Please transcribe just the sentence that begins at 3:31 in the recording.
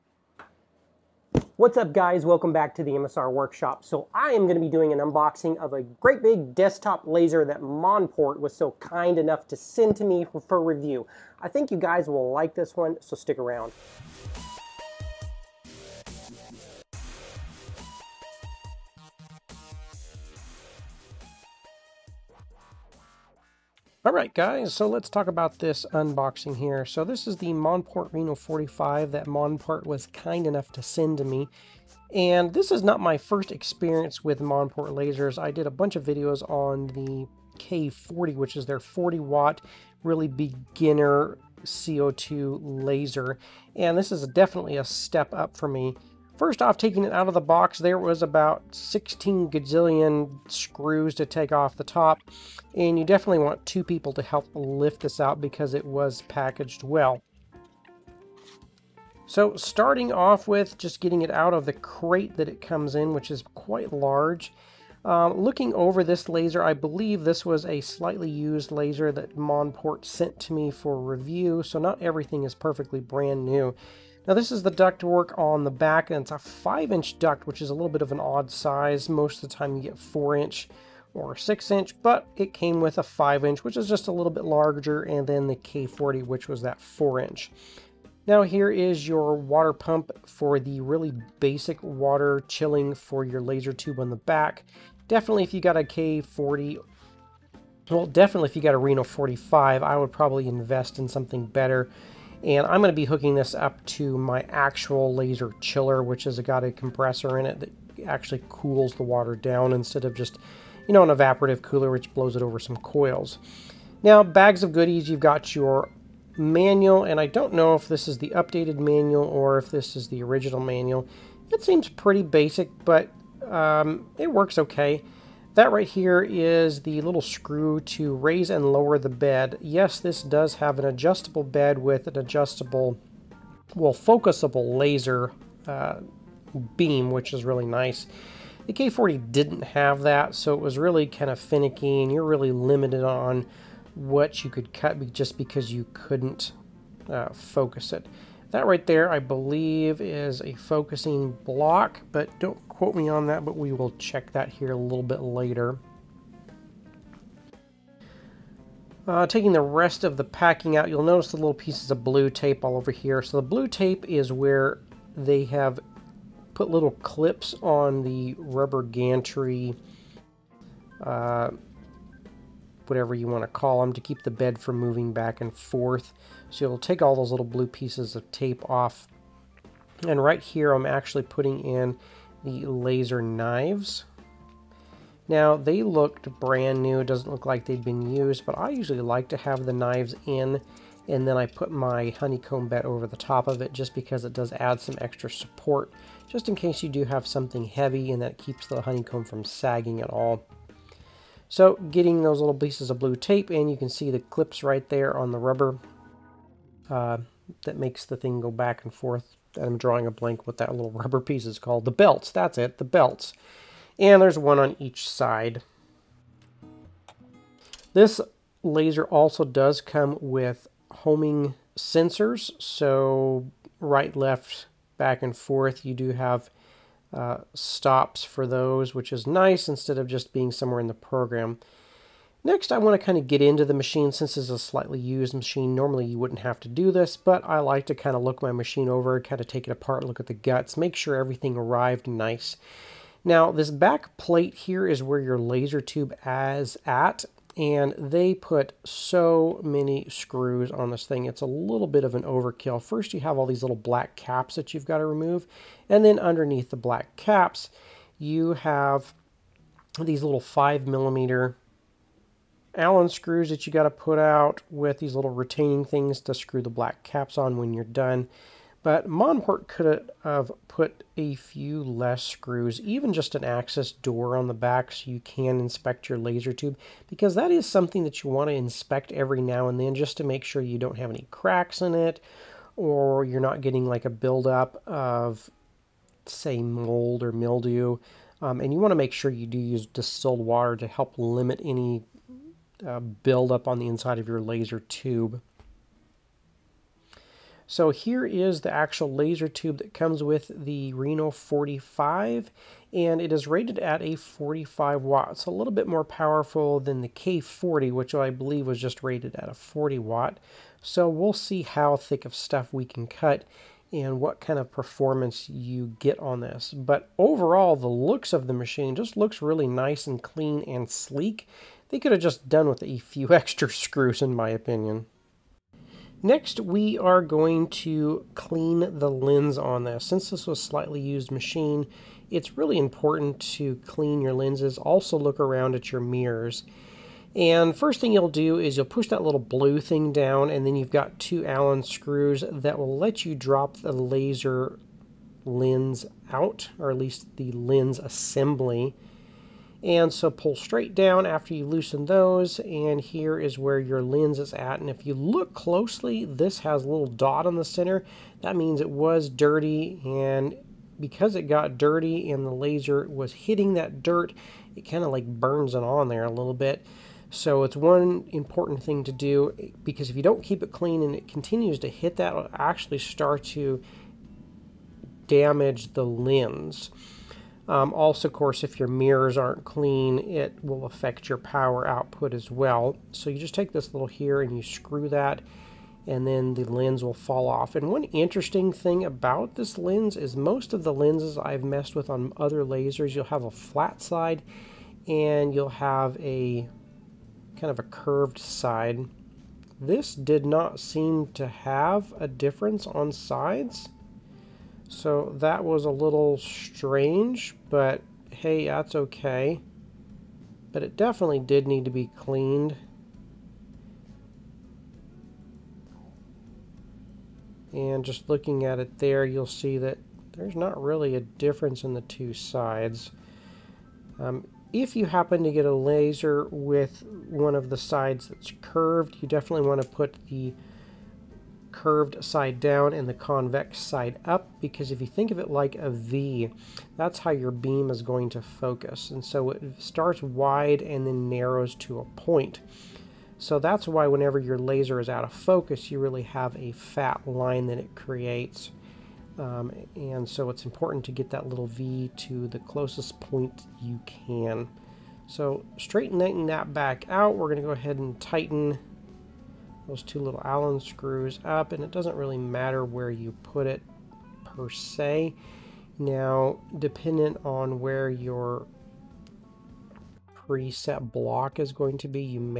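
The belts, that's it, the belts.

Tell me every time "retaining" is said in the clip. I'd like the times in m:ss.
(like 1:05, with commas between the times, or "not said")
4:25.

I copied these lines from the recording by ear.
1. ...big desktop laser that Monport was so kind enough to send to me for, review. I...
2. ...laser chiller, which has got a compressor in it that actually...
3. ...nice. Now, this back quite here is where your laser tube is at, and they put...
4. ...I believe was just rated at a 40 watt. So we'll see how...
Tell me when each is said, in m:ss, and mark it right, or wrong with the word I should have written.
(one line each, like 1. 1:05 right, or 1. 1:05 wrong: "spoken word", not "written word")
1. 0:06 right
2. 1:45 right
3. 4:02 wrong: "plate", not "quite"
4. 5:08 right.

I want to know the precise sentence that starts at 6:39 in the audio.
This did not seem to have a difference on sides.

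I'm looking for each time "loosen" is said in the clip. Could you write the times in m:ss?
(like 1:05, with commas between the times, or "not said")
5:51.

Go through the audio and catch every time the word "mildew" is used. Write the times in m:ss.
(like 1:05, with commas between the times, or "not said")
4:47.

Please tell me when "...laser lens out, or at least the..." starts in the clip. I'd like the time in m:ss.
5:43.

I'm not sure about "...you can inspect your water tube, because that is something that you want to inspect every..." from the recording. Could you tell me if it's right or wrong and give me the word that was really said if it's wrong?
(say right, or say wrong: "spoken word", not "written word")
wrong: "laser", not "water".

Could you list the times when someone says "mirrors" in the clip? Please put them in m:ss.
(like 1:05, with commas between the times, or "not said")
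5:36, 6:18.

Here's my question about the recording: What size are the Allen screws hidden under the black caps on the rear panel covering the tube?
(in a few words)
5 millimeter.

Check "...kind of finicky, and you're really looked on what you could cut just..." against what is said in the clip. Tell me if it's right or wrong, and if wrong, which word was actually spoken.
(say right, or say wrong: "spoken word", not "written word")
wrong: "limited", not "looked".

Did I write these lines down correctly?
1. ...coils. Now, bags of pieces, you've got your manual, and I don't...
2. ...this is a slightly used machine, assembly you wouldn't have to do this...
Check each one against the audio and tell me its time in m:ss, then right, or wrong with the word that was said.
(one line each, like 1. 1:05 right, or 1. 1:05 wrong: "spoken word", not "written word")
1. 1:52 wrong: "goodies", not "pieces"
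2. 3:54 wrong: "normally", not "assembly".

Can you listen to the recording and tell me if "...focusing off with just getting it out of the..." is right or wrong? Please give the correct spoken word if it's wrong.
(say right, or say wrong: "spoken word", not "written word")
wrong: "starting", not "focusing".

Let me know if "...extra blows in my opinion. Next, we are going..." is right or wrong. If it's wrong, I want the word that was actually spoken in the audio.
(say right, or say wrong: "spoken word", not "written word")
wrong: "screws", not "blows".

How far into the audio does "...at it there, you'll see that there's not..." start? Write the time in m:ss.
6:58.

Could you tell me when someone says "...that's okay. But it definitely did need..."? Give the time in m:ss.
6:48.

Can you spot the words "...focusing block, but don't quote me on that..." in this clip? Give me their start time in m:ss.
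2:30.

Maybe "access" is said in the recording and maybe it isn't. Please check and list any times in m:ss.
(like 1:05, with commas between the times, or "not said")
4:33.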